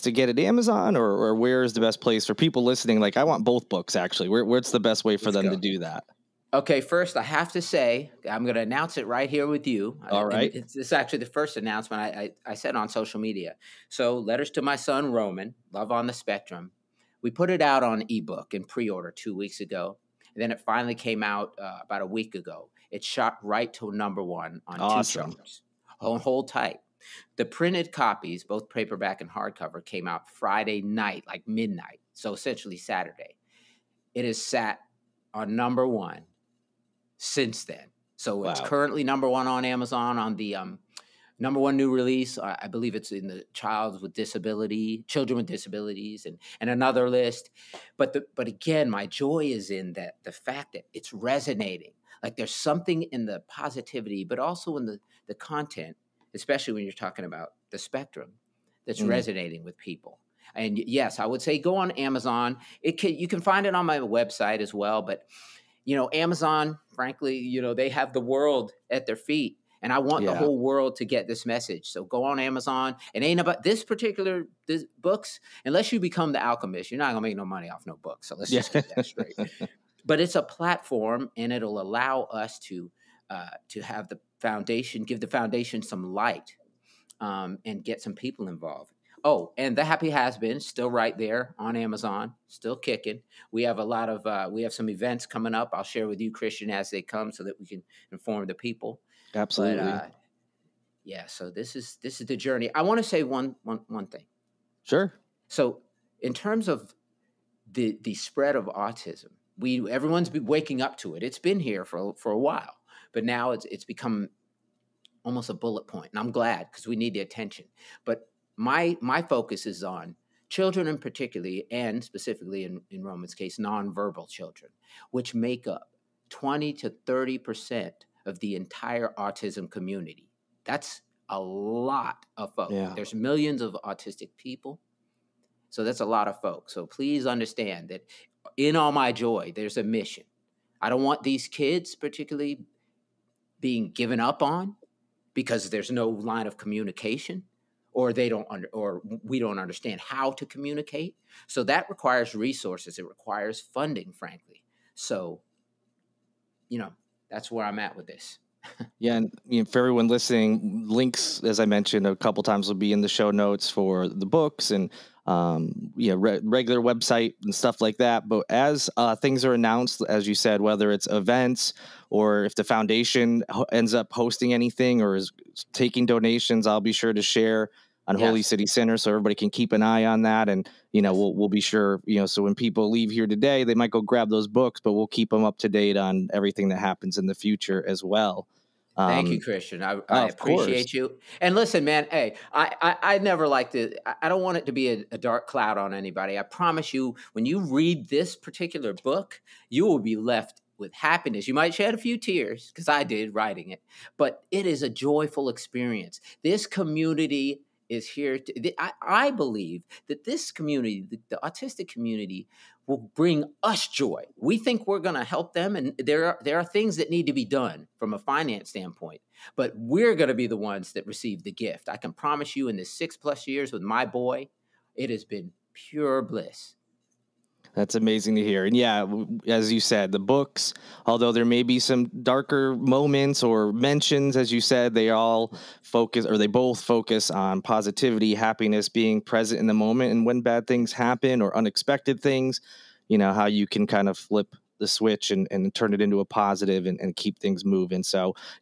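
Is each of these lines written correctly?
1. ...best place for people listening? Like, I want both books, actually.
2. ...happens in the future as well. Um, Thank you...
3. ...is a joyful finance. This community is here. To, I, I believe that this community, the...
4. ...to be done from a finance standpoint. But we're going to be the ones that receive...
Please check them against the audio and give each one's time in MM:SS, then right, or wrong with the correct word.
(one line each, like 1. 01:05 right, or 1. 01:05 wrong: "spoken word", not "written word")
1. 00:01 right
2. 03:06 right
3. 03:24 wrong: "experience", not "finance"
4. 03:37 right.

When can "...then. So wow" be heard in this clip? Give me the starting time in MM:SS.
00:37.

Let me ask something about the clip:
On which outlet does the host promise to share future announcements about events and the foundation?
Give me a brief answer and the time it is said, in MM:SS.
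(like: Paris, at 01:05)
Holy City Sinner, at 02:58.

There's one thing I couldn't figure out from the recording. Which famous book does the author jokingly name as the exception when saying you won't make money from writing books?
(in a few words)
The Alchemist.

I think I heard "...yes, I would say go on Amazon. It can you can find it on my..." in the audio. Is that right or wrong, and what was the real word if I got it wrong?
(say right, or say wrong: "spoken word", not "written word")
right.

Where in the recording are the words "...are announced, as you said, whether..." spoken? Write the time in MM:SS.
02:49.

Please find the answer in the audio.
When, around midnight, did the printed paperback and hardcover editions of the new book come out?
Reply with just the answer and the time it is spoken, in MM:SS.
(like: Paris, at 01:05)
Friday night, at 00:30.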